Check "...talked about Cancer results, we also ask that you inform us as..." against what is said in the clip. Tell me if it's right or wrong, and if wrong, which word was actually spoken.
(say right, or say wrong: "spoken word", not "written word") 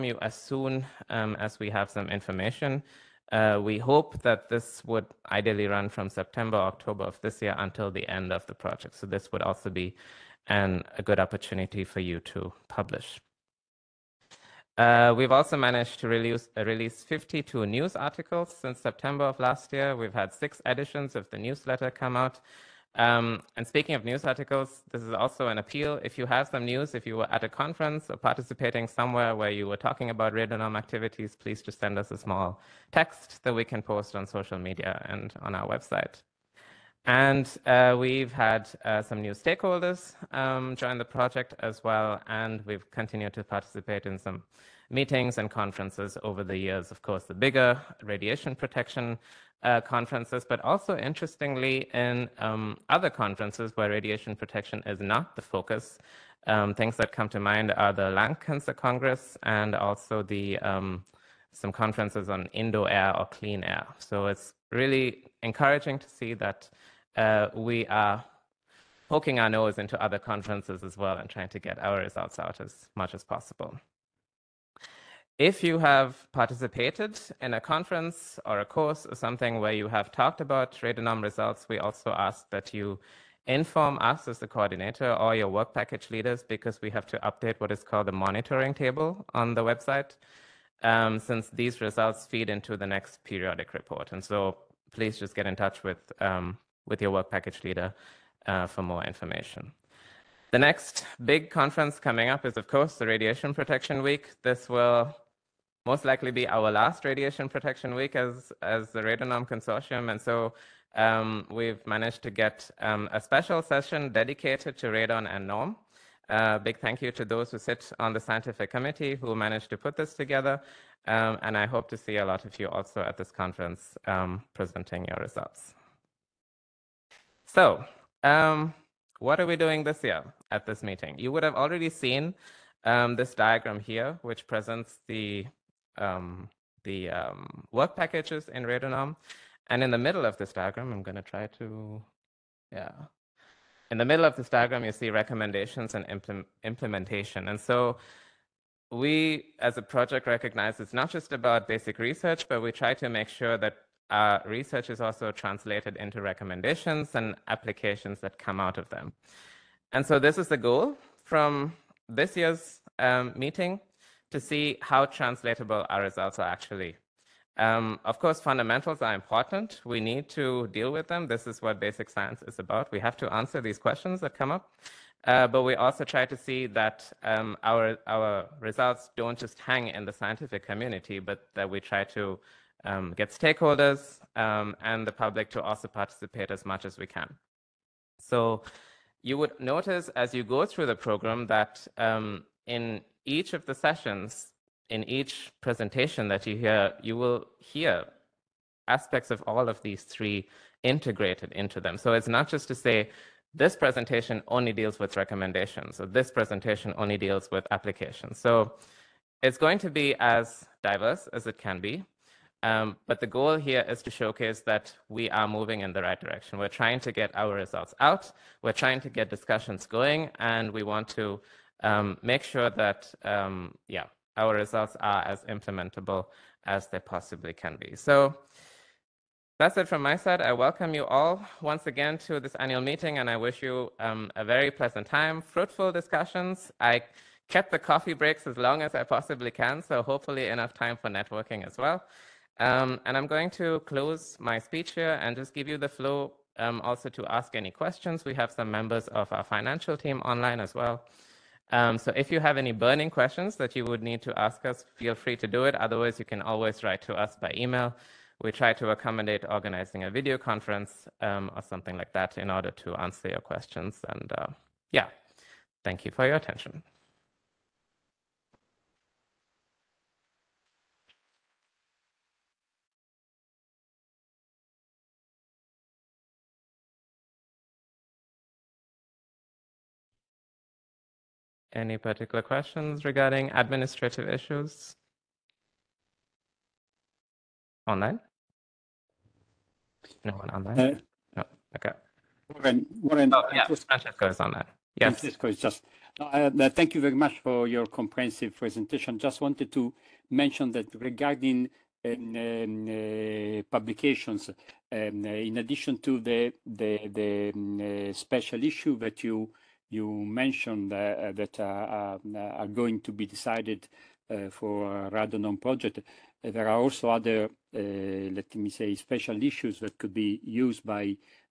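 wrong: "RadoNorm", not "Cancer".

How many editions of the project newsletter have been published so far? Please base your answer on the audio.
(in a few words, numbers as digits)
6.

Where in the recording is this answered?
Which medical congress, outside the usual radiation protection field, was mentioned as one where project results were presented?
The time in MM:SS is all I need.
00:58.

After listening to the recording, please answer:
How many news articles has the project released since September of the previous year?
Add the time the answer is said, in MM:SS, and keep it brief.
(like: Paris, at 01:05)
52, at 00:17.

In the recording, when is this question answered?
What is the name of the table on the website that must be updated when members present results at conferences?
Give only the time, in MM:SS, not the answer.
01:28.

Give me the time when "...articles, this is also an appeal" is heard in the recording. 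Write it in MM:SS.
00:24.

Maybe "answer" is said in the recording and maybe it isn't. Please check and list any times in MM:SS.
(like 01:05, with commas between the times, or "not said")
02:53, 04:22.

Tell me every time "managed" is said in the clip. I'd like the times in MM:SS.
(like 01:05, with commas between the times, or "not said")
00:15, 01:51, 01:59.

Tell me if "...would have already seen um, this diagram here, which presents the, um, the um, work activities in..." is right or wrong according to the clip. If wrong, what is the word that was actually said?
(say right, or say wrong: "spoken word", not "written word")
wrong: "packages", not "activities".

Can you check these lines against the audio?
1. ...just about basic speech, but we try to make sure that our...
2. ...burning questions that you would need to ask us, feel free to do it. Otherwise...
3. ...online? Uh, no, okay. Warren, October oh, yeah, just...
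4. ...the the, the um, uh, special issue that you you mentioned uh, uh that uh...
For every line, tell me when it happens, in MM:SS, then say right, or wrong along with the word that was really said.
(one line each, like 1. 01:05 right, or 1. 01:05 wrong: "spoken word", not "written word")
1. 02:31 wrong: "research", not "speech"
2. 04:12 right
3. 04:50 wrong: "Warren", not "October"
4. 05:06 right.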